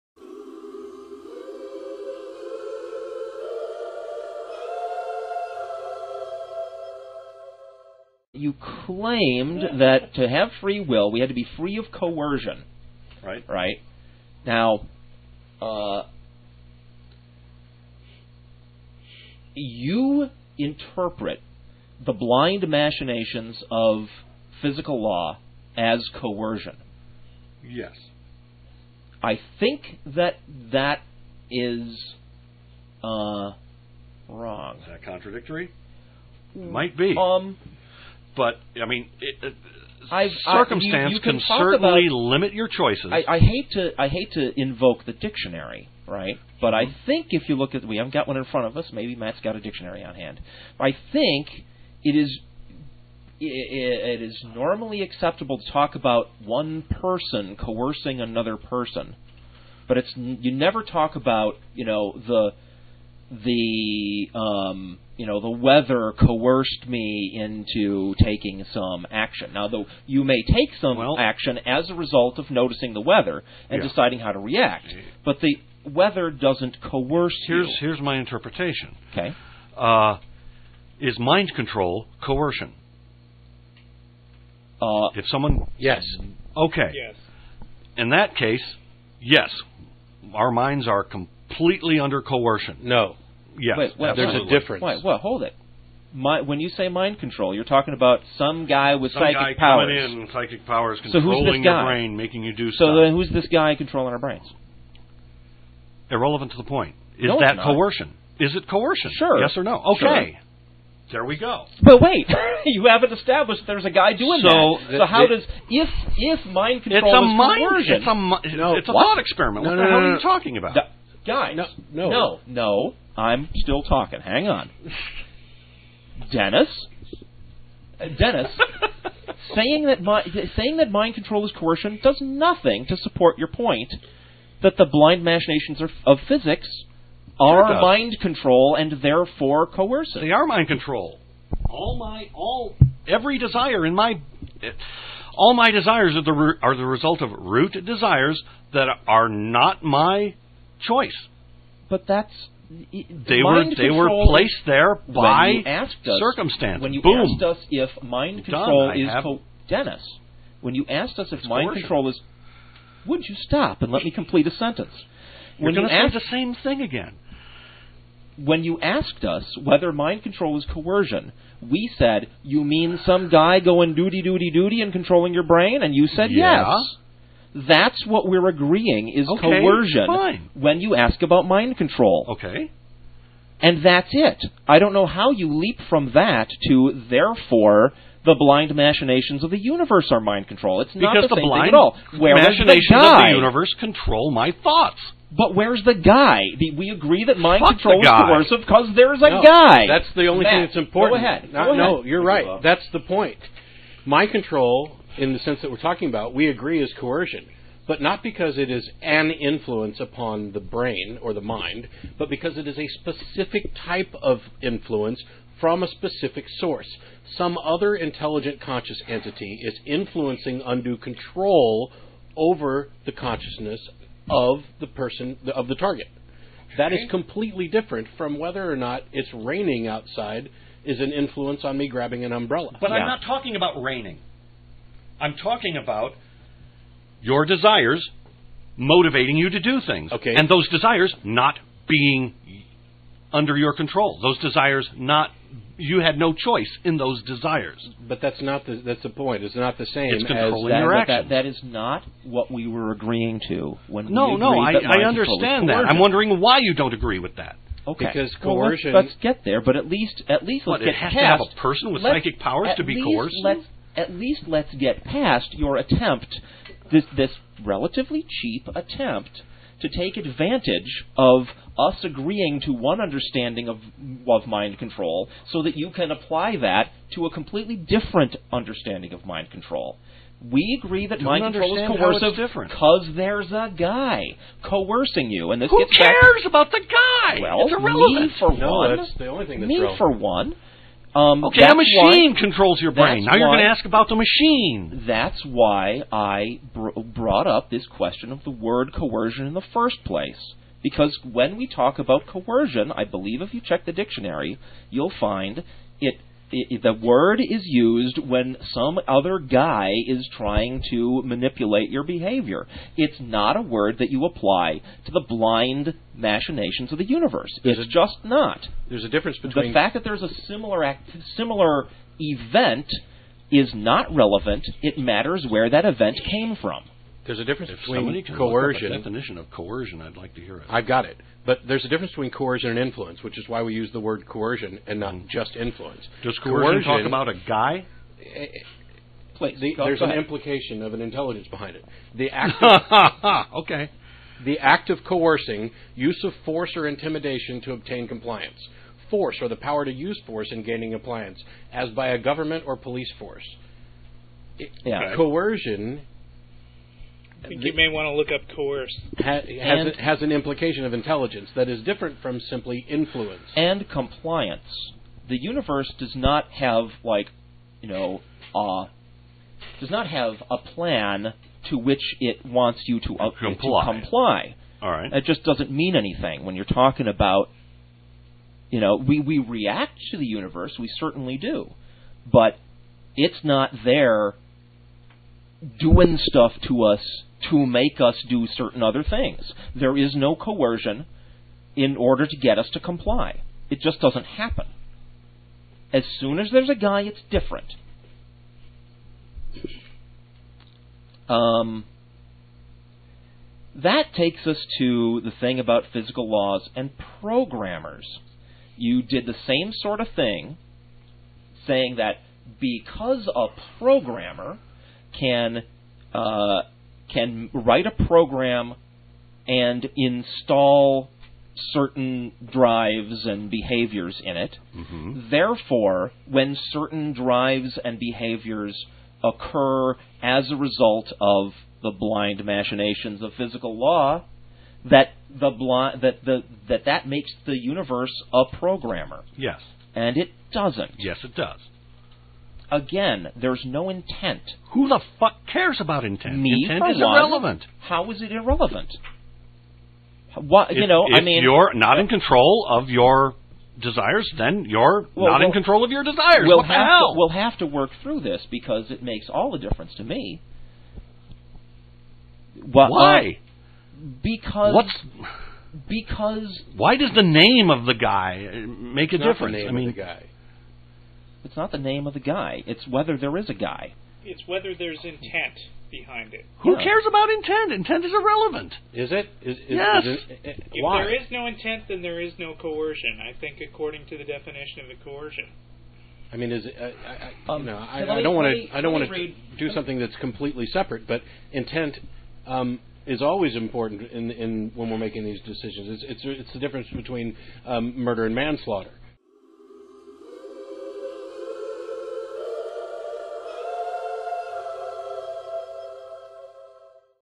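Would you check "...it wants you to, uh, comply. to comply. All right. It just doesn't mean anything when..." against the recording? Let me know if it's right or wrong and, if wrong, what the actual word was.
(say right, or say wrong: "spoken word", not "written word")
right.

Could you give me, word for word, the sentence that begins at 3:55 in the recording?
I'm talking about your desires motivating you to do things.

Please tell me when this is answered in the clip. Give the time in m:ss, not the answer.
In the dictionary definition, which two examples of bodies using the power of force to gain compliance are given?
5:52.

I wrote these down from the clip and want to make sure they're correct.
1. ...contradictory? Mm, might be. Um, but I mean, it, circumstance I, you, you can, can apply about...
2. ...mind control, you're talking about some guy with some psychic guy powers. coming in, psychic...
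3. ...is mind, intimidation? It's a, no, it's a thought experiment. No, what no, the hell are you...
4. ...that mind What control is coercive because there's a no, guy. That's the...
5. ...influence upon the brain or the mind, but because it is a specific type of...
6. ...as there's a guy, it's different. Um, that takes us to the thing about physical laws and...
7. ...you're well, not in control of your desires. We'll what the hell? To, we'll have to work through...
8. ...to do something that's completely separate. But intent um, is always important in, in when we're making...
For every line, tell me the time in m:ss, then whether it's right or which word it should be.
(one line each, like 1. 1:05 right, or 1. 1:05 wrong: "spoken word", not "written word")
1. 0:35 wrong: "certainly", not "apply"
2. 1:36 right
3. 1:57 wrong: "coercion", not "intimidation"
4. 3:17 wrong: "Fuck", not "What"
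5. 3:29 right
6. 6:36 right
7. 7:34 right
8. 8:09 right.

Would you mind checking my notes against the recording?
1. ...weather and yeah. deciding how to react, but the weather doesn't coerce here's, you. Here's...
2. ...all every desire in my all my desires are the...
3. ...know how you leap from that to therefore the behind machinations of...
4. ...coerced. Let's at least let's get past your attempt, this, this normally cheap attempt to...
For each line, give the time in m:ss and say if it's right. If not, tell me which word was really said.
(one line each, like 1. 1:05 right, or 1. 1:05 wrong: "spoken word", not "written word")
1. 1:13 right
2. 2:22 right
3. 3:04 wrong: "blind", not "behind"
4. 4:23 wrong: "relatively", not "normally".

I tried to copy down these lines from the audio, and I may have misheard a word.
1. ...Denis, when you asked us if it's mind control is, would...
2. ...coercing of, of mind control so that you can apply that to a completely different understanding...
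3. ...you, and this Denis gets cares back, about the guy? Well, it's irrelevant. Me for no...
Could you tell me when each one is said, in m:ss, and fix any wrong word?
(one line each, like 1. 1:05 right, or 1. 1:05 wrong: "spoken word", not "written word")
1. 2:39 right
2. 4:33 wrong: "understanding", not "coercing"
3. 4:45 wrong: "Who", not "Denis".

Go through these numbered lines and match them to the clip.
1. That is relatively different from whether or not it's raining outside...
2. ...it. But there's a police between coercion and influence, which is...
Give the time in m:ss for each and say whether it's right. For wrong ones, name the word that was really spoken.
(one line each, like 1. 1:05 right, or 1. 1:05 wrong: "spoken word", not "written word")
1. 3:46 wrong: "completely", not "relatively"
2. 5:31 wrong: "difference", not "police".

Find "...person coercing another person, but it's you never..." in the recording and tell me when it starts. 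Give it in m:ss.
0:56.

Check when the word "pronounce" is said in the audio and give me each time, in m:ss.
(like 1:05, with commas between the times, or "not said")
not said.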